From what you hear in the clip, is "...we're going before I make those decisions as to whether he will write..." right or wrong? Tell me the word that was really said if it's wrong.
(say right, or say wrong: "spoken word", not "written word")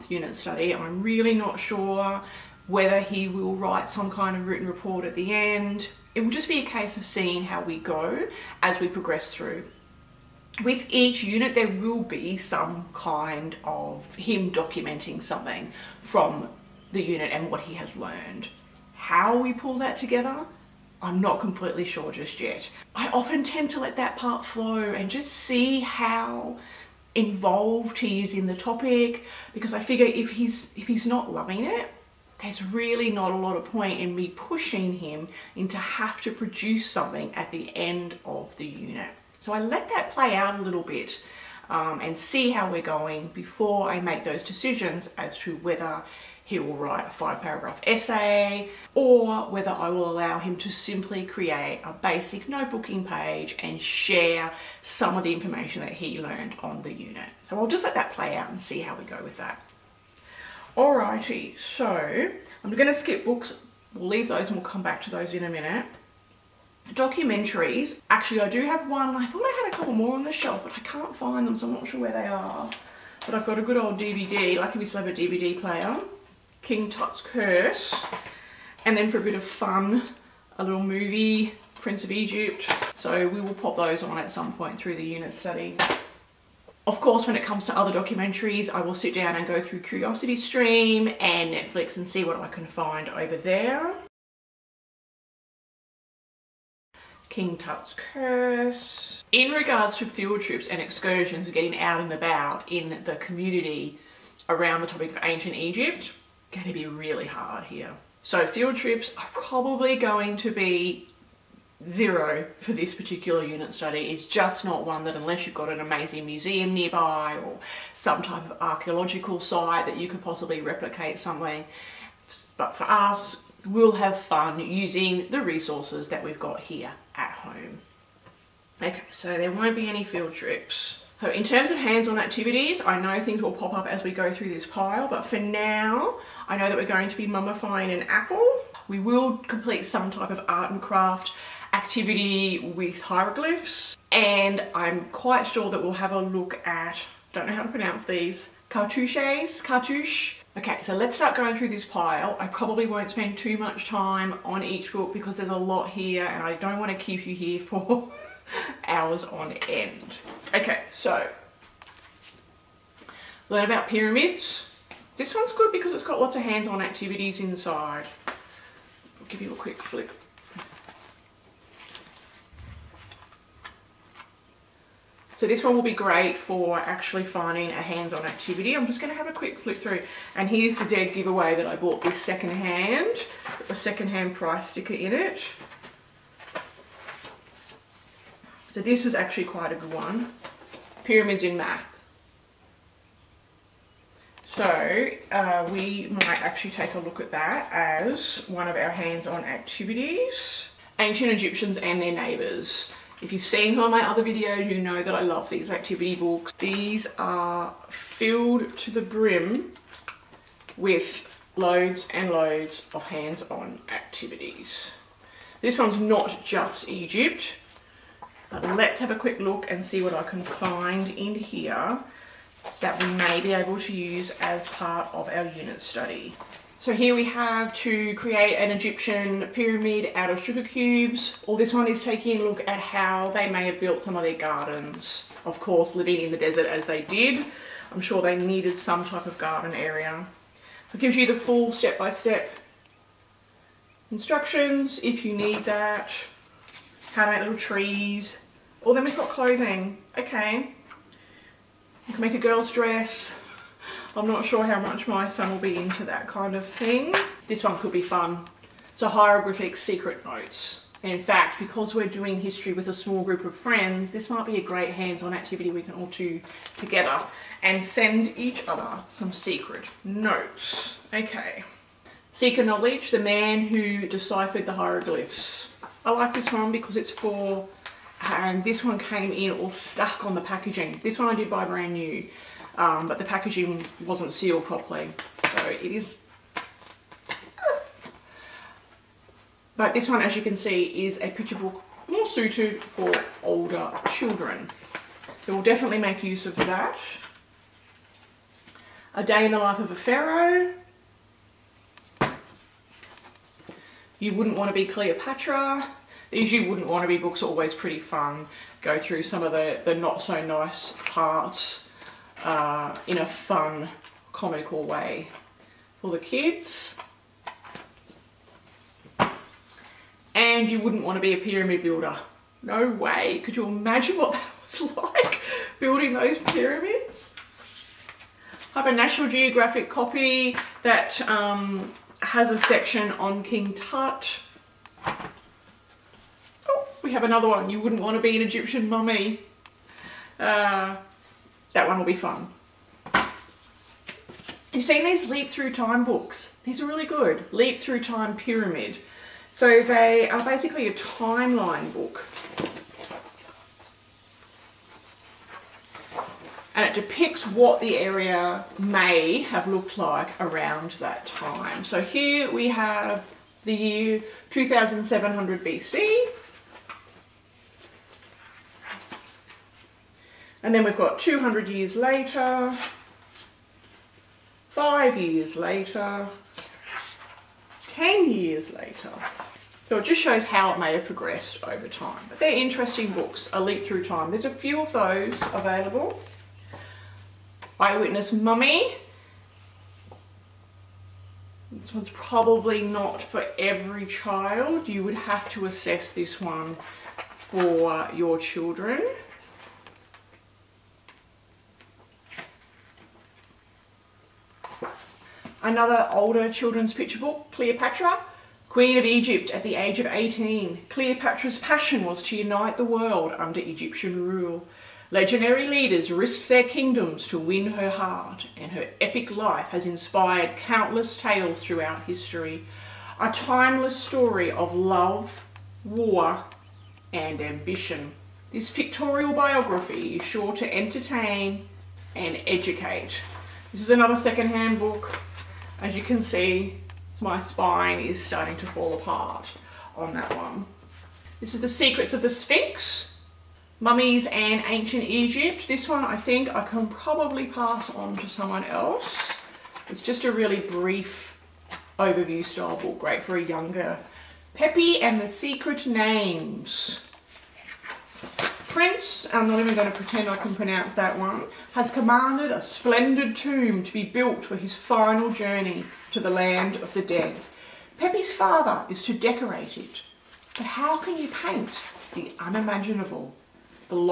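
right.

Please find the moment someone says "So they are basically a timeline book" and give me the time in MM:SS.
05:49.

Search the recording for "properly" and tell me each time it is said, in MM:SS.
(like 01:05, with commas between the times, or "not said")
04:44.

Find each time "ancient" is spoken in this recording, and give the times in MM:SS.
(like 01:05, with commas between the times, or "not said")
01:45, 03:20, 07:24.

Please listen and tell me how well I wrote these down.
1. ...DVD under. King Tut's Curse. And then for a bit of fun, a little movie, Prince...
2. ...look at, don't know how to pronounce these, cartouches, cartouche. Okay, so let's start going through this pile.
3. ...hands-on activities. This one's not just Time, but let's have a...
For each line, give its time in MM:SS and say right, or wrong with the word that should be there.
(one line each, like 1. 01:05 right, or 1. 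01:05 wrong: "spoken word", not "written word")
1. 01:15 wrong: "player", not "under"
2. 02:26 right
3. 03:33 wrong: "Egypt", not "Time".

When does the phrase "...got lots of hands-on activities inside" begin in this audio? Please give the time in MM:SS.
02:46.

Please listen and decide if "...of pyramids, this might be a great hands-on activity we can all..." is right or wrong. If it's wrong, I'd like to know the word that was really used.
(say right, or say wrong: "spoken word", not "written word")
wrong: "friends", not "pyramids".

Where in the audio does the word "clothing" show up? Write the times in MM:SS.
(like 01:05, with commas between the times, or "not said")
04:09.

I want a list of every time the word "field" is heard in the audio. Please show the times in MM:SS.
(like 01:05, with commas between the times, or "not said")
01:40, 01:48, 02:10.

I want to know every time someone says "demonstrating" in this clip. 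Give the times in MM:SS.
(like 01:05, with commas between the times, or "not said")
not said.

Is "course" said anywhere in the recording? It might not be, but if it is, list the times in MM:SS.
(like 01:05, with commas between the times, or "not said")
01:26, 03:55.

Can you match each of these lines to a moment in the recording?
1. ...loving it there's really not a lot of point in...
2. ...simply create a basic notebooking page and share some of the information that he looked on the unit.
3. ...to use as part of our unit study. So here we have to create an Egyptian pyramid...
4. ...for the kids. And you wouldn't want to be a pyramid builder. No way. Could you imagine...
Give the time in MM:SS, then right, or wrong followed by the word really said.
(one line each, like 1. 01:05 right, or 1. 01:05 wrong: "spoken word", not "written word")
1. 00:31 right
2. 00:50 wrong: "learned", not "looked"
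3. 03:43 right
4. 05:15 right.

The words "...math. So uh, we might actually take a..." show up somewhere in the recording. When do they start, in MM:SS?
03:11.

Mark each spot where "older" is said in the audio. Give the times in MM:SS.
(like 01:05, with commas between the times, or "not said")
04:53, 06:46.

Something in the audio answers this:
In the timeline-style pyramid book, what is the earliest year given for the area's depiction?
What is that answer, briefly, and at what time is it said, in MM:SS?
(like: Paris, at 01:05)
2700 BC, at 06:04.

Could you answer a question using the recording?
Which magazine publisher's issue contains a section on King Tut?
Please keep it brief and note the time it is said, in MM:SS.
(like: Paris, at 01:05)
National Geographic, at 05:28.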